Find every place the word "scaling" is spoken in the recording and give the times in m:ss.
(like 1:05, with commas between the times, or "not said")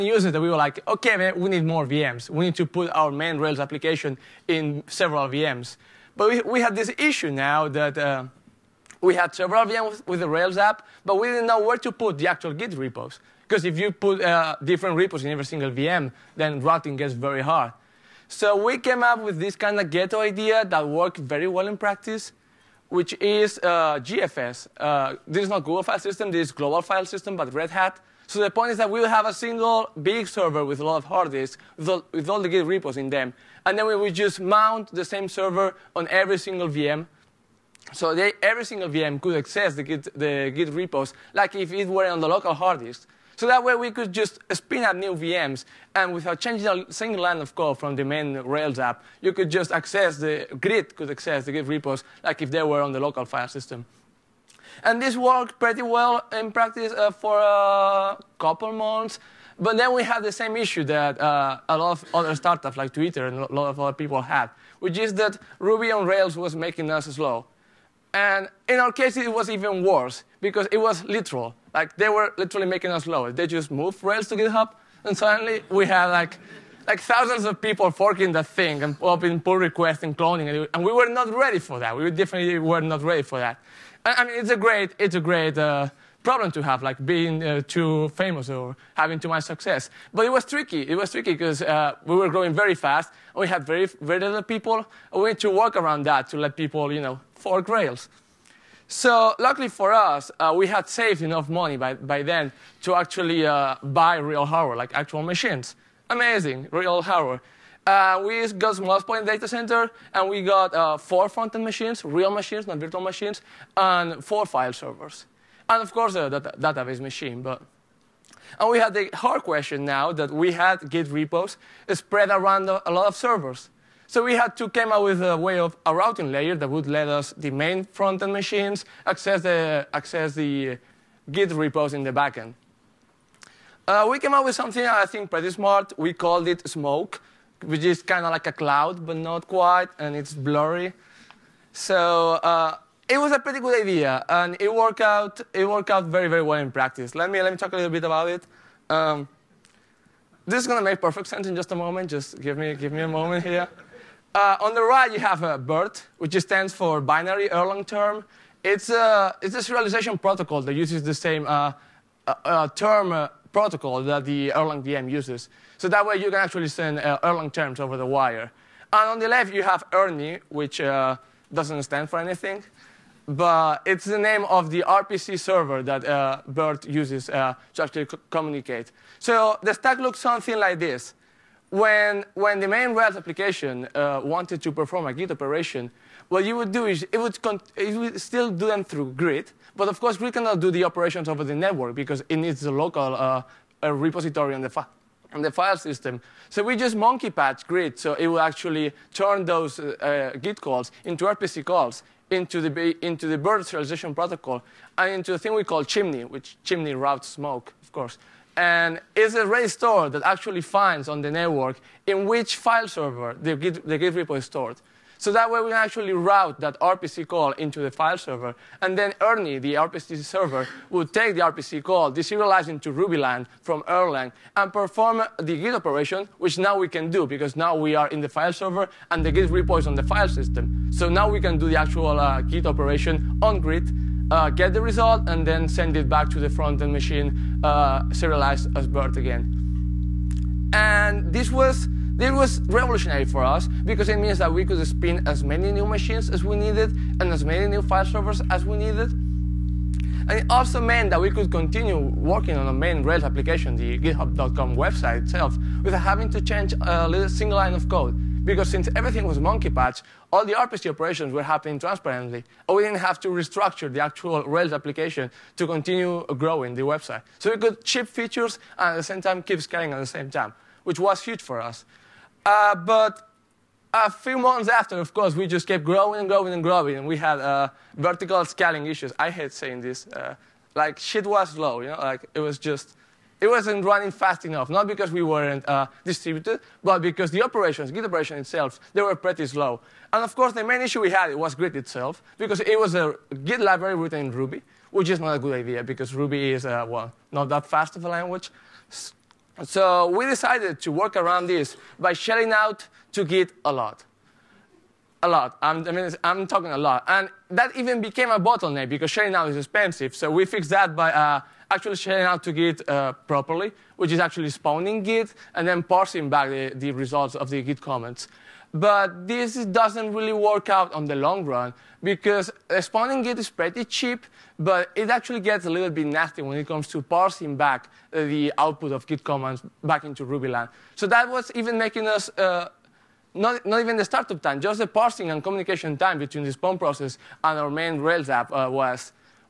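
4:29, 4:38.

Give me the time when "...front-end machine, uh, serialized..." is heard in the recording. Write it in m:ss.
3:56.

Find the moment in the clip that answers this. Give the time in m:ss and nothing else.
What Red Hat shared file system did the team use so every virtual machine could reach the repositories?
0:26.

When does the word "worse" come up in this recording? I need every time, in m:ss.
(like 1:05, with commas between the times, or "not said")
1:09.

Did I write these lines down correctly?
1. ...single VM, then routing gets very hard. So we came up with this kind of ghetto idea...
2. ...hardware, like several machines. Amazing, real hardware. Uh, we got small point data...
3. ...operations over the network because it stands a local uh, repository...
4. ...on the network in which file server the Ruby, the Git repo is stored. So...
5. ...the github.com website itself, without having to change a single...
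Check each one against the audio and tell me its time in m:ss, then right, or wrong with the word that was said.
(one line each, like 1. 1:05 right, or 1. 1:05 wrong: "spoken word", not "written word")
1. 0:15 right
2. 1:44 wrong: "actual", not "several"
3. 3:10 wrong: "needs", not "stands"
4. 3:31 wrong: "Git", not "Ruby"
5. 4:13 right.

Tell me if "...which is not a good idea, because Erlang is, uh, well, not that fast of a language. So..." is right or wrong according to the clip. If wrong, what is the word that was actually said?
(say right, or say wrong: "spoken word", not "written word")
wrong: "Ruby", not "Erlang".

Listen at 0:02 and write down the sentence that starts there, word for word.
We need to put our main Rails application in several VMs.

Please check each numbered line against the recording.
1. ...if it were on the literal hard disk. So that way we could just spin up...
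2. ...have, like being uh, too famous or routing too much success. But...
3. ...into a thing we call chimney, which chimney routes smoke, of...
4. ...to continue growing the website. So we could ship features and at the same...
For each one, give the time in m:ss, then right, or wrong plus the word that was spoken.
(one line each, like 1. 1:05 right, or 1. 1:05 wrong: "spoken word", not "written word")
1. 0:41 wrong: "local", not "literal"
2. 1:26 wrong: "having", not "routing"
3. 3:25 right
4. 4:25 right.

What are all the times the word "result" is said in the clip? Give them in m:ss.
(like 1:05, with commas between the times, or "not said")
3:54, 5:16.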